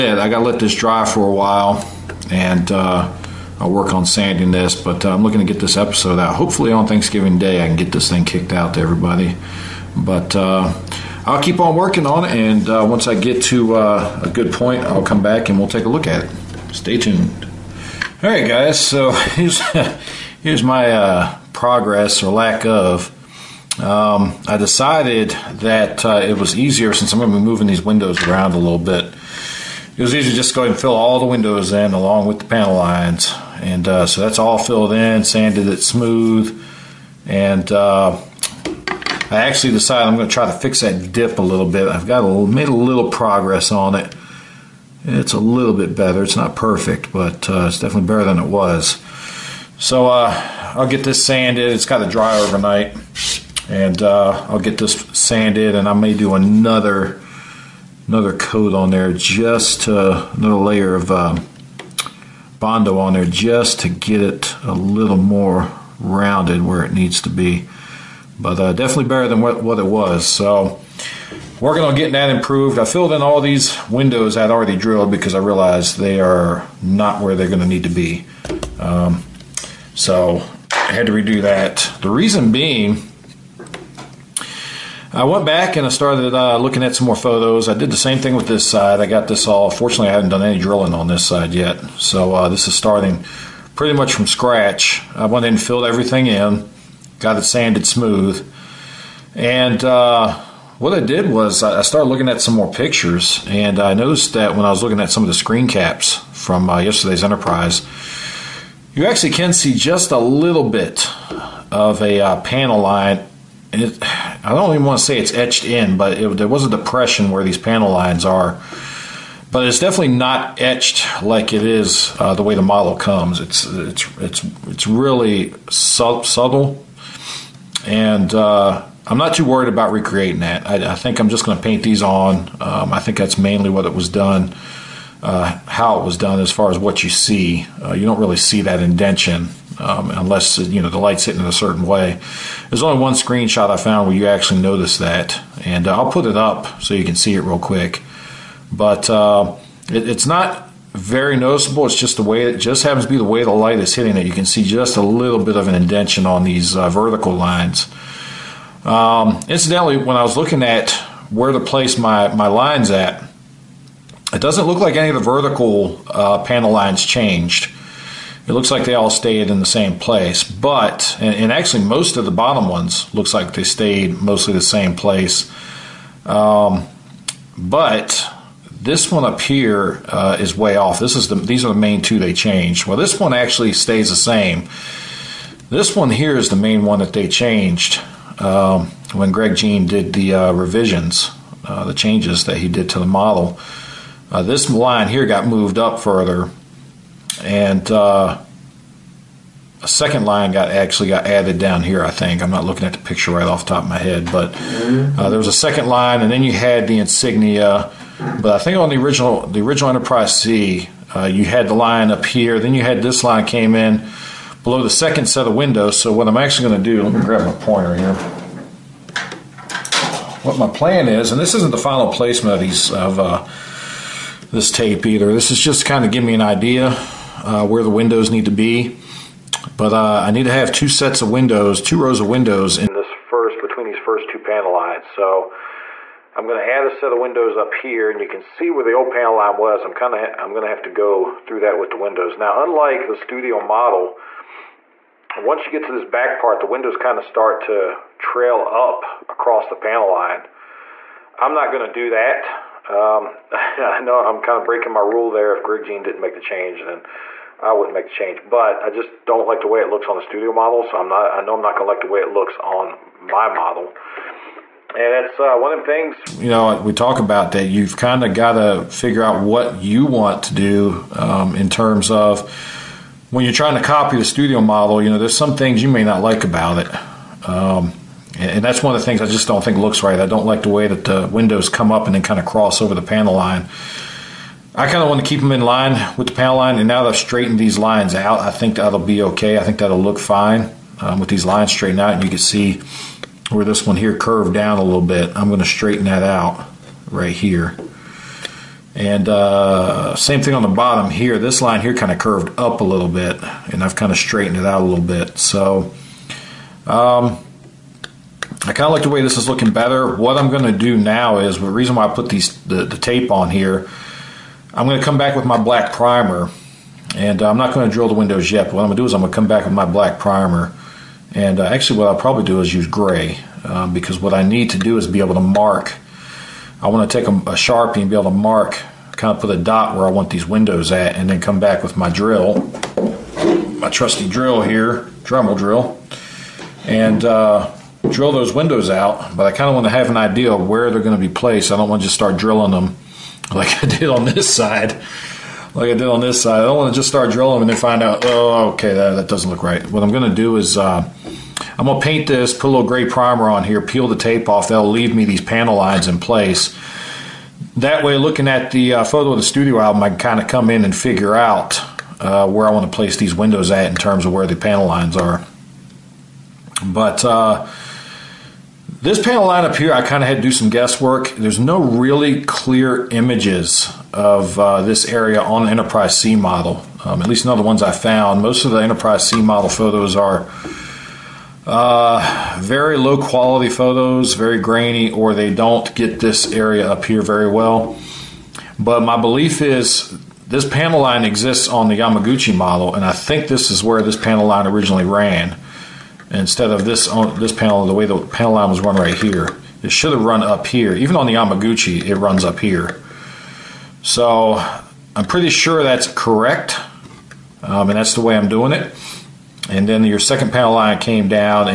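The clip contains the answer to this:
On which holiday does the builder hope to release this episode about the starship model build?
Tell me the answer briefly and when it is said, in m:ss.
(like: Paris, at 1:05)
Thanksgiving Day, at 0:06.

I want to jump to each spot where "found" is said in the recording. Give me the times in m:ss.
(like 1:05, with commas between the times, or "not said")
2:23, 6:17.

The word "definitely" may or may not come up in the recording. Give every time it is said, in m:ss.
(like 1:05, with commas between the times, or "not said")
0:47, 1:08, 1:59.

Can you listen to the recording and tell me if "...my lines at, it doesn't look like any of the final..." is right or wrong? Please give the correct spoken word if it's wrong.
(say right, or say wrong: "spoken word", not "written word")
wrong: "vertical", not "final".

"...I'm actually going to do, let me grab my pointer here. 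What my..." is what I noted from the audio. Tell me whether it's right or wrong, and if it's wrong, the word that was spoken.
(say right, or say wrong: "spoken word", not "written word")
right.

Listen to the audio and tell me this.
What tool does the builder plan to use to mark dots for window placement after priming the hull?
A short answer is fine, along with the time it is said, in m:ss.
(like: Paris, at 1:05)
Sharpie, at 5:27.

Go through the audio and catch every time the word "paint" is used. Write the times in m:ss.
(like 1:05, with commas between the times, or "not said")
2:11, 5:52.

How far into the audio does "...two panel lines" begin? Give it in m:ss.
3:54.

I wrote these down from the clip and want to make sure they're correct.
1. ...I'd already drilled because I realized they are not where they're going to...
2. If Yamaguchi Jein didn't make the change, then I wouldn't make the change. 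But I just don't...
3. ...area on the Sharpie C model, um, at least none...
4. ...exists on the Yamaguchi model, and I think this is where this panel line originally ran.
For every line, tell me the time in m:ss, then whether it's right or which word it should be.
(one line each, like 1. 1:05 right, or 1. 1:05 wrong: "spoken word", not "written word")
1. 1:14 right
2. 4:15 wrong: "Greg", not "Yamaguchi"
3. 6:15 wrong: "Enterprise", not "Sharpie"
4. 6:31 right.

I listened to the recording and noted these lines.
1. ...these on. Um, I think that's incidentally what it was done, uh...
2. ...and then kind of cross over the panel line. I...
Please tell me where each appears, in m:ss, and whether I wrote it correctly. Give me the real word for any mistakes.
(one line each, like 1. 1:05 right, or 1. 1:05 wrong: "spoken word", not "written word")
1. 2:11 wrong: "mainly", not "incidentally"
2. 4:42 right.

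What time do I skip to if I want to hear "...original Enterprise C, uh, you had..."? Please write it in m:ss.
3:29.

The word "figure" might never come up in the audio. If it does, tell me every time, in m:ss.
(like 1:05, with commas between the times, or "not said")
4:28, 6:00.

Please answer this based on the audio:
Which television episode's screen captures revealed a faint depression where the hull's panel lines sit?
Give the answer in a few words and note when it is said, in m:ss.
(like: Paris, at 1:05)
Yesterday's Enterprise, at 1:46.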